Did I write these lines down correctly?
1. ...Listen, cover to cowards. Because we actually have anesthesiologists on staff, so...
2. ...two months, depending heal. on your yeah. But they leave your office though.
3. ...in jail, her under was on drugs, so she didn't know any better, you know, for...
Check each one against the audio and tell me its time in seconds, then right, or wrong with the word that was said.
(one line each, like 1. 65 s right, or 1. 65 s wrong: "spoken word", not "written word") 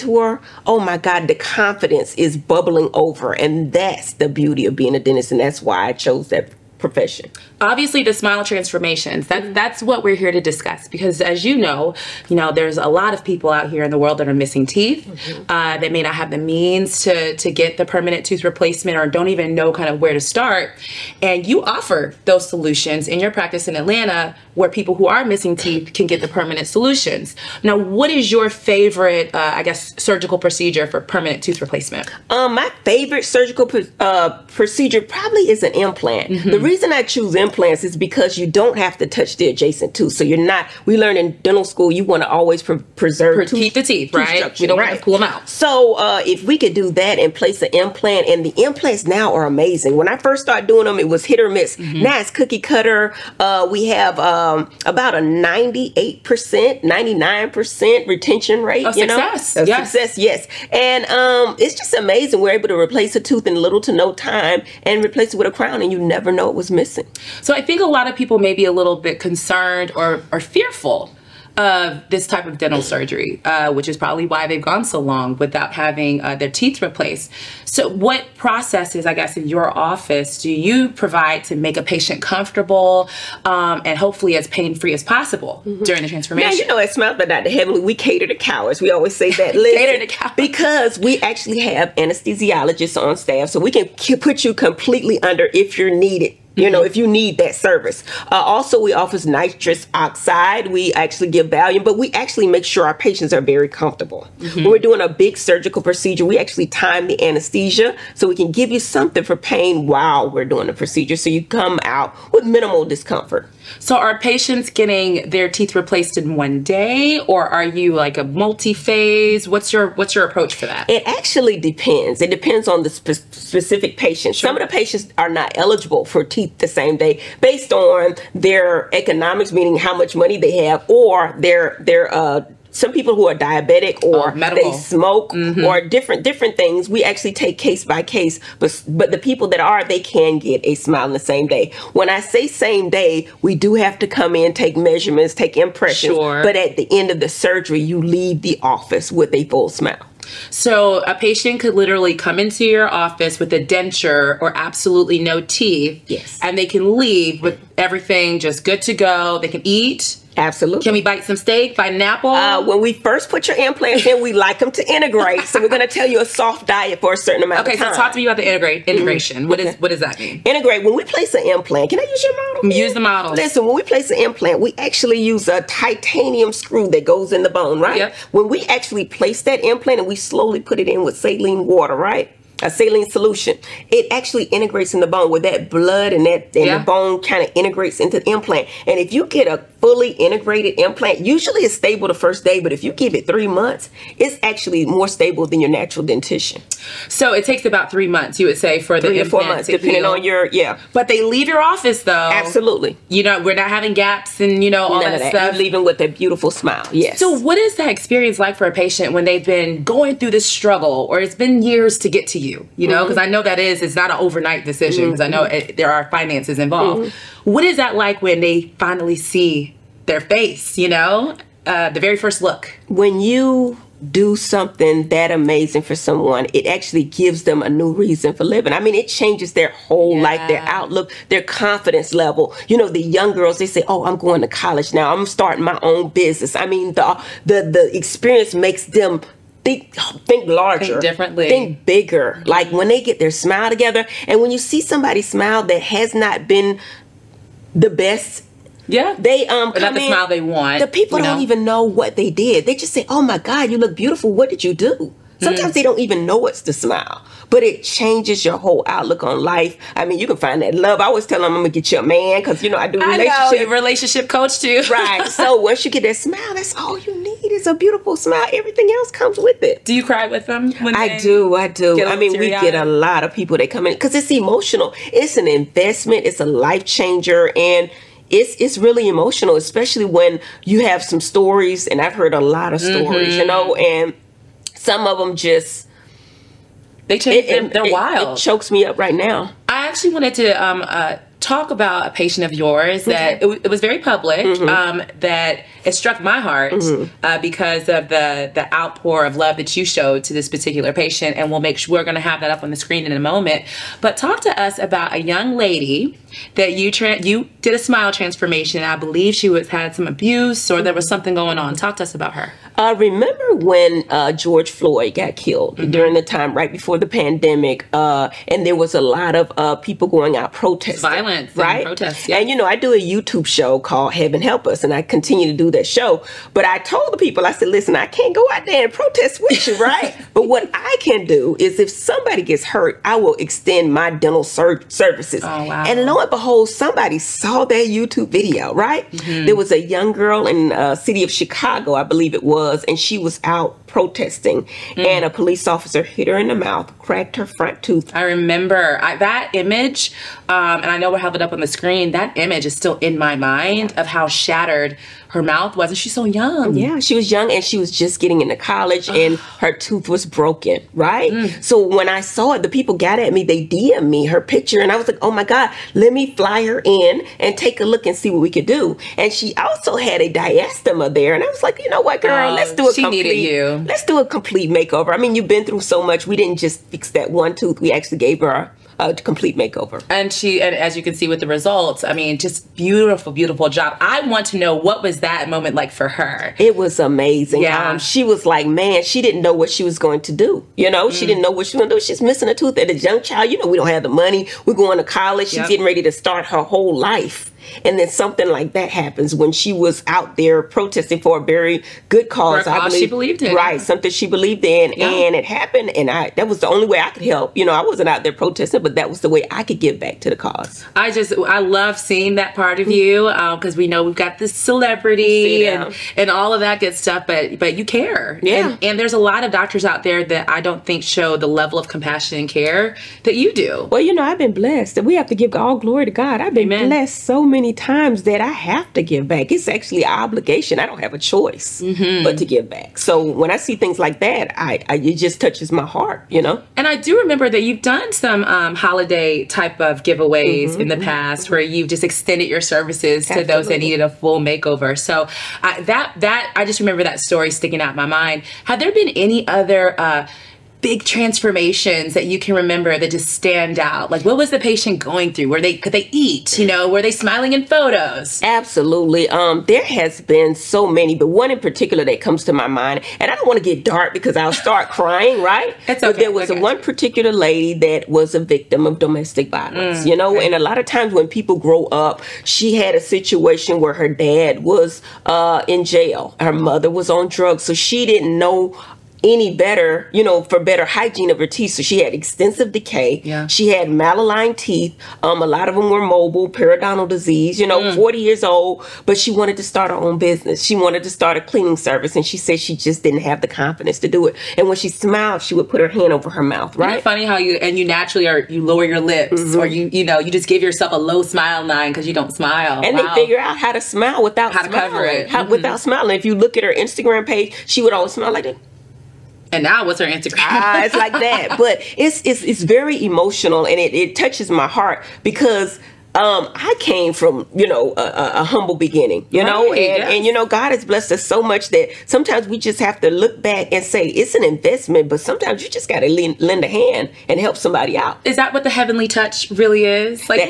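1. 89 s wrong: "cater", not "cover"
2. 199 s wrong: "four", not "two"
3. 475 s wrong: "mother", not "under".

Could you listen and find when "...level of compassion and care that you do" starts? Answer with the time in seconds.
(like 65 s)
421 s.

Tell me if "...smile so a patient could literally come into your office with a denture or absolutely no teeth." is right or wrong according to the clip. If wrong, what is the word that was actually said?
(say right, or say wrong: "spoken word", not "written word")
right.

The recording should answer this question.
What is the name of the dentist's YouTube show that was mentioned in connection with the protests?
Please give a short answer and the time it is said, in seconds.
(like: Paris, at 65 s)
Heaven Help Us, at 324 s.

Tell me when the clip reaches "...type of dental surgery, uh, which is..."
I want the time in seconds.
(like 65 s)
72 s.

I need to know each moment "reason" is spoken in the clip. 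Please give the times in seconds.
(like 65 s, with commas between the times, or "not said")
36 s, 227 s.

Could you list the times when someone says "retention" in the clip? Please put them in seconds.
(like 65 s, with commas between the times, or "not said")
58 s.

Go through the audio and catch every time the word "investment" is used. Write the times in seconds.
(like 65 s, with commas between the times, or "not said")
275 s, 524 s.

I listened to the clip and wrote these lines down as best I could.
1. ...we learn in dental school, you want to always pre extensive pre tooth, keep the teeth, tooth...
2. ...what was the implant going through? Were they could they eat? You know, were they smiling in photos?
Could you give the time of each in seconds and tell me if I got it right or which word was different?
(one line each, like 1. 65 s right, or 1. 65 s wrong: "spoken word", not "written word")
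1. 40 s wrong: "preserve", not "extensive"
2. 454 s wrong: "patient", not "implant".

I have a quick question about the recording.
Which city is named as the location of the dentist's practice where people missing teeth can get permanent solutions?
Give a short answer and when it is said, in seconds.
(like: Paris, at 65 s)
Atlanta, at 23 s.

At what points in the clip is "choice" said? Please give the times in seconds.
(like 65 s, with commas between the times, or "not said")
431 s.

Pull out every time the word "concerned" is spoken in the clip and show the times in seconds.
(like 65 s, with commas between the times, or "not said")
69 s.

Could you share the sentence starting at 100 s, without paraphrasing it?
We actually give Valium, but we actually make sure our patients are very comfortable.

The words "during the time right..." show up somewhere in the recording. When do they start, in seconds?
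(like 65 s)
315 s.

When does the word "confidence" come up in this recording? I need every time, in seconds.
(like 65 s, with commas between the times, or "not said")
1 s, 231 s, 493 s.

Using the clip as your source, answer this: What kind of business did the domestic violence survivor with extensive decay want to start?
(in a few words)
Cleaning service.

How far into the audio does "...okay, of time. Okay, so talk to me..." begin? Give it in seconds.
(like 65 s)
167 s.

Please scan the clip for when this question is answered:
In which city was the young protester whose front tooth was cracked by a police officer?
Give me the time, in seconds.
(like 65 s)
341 s.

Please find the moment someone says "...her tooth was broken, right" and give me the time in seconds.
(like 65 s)
359 s.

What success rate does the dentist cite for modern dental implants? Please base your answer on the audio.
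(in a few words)
99%.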